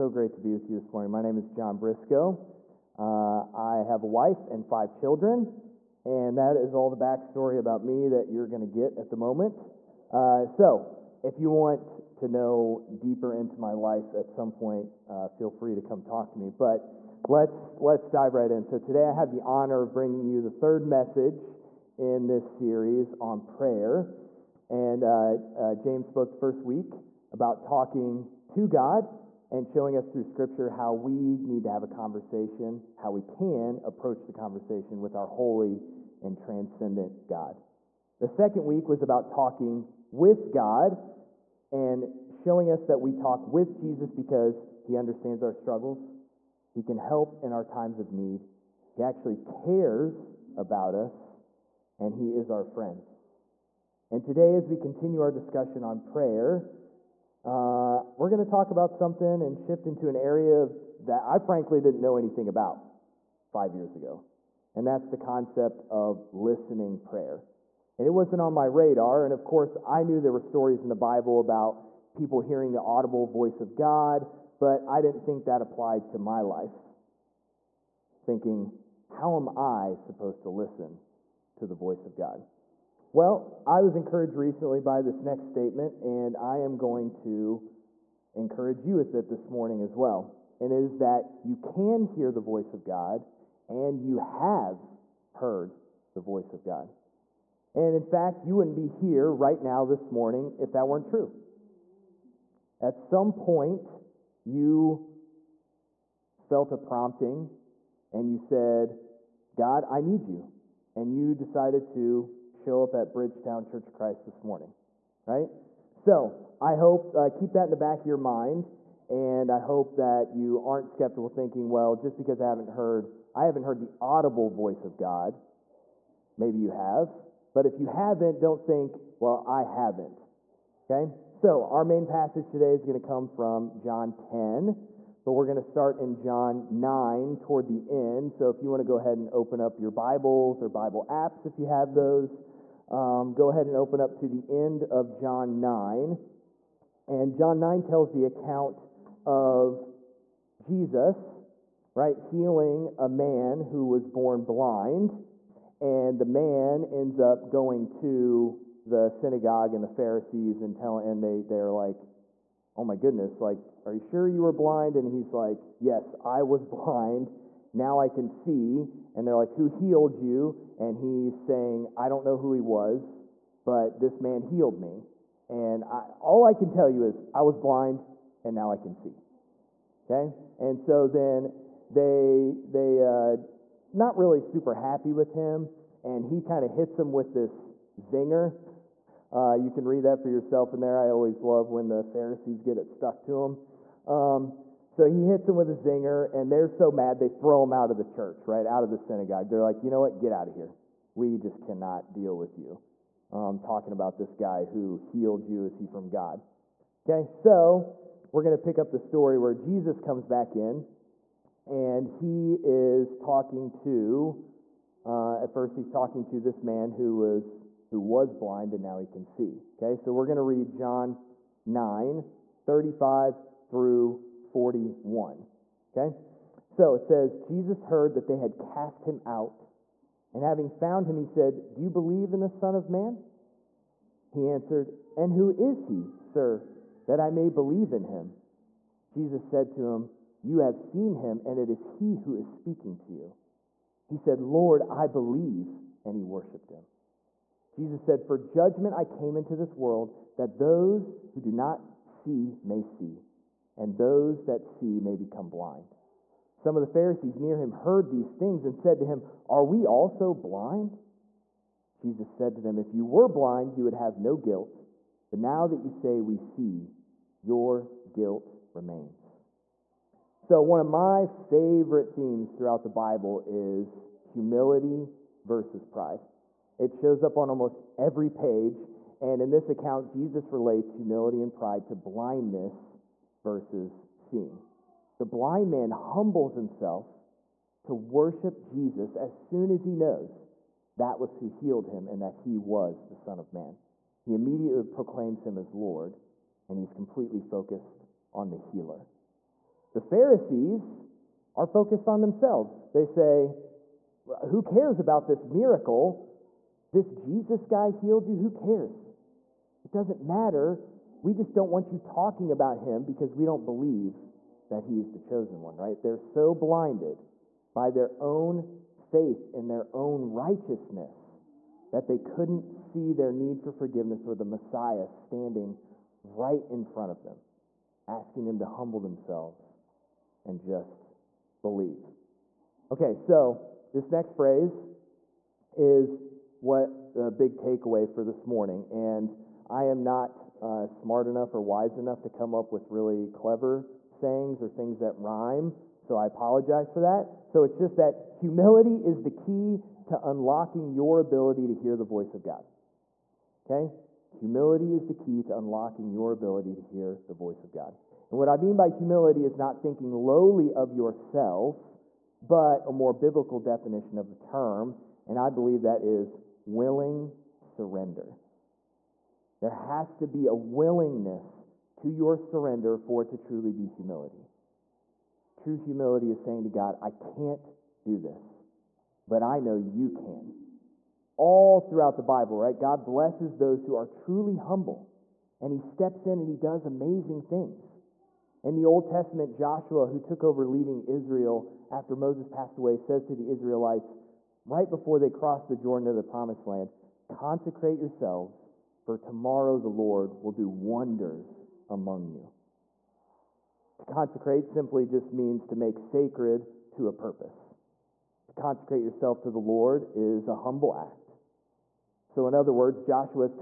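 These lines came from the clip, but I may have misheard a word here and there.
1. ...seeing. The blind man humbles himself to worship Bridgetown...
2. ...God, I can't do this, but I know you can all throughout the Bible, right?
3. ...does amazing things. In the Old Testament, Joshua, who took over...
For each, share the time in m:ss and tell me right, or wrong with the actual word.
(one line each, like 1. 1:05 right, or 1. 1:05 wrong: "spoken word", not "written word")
1. 4:44 wrong: "Jesus", not "Bridgetown"
2. 6:16 right
3. 6:26 right.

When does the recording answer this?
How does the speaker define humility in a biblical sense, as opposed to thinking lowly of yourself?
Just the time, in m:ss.
6:06.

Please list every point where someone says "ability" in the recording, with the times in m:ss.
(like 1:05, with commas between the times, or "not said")
5:51, 5:56.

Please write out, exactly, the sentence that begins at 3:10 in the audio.
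I always love when the Pharisees get it stuck to them.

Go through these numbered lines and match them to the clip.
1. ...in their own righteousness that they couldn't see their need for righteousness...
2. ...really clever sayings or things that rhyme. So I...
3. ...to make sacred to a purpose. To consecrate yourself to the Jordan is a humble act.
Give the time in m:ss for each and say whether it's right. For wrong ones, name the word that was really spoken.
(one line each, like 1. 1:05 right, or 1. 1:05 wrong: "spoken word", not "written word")
1. 5:19 wrong: "forgiveness", not "righteousness"
2. 5:42 right
3. 6:45 wrong: "Lord", not "Jordan".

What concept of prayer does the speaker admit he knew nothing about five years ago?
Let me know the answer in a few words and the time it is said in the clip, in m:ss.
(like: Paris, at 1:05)
listening prayer, at 1:06.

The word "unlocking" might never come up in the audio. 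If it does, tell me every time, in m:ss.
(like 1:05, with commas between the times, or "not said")
5:50, 5:55.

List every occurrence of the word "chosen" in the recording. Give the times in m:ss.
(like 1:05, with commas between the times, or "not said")
5:15.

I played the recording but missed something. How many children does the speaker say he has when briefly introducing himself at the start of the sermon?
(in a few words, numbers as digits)
5.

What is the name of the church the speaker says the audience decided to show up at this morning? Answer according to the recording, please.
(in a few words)
Bridgetown Church of Christ.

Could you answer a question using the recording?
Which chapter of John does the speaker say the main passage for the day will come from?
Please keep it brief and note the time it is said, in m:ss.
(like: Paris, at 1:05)
John 10, at 2:13.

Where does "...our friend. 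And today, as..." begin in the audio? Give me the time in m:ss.
0:52.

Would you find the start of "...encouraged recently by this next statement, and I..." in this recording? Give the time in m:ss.
1:23.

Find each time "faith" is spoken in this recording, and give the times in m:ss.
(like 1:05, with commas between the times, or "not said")
5:18.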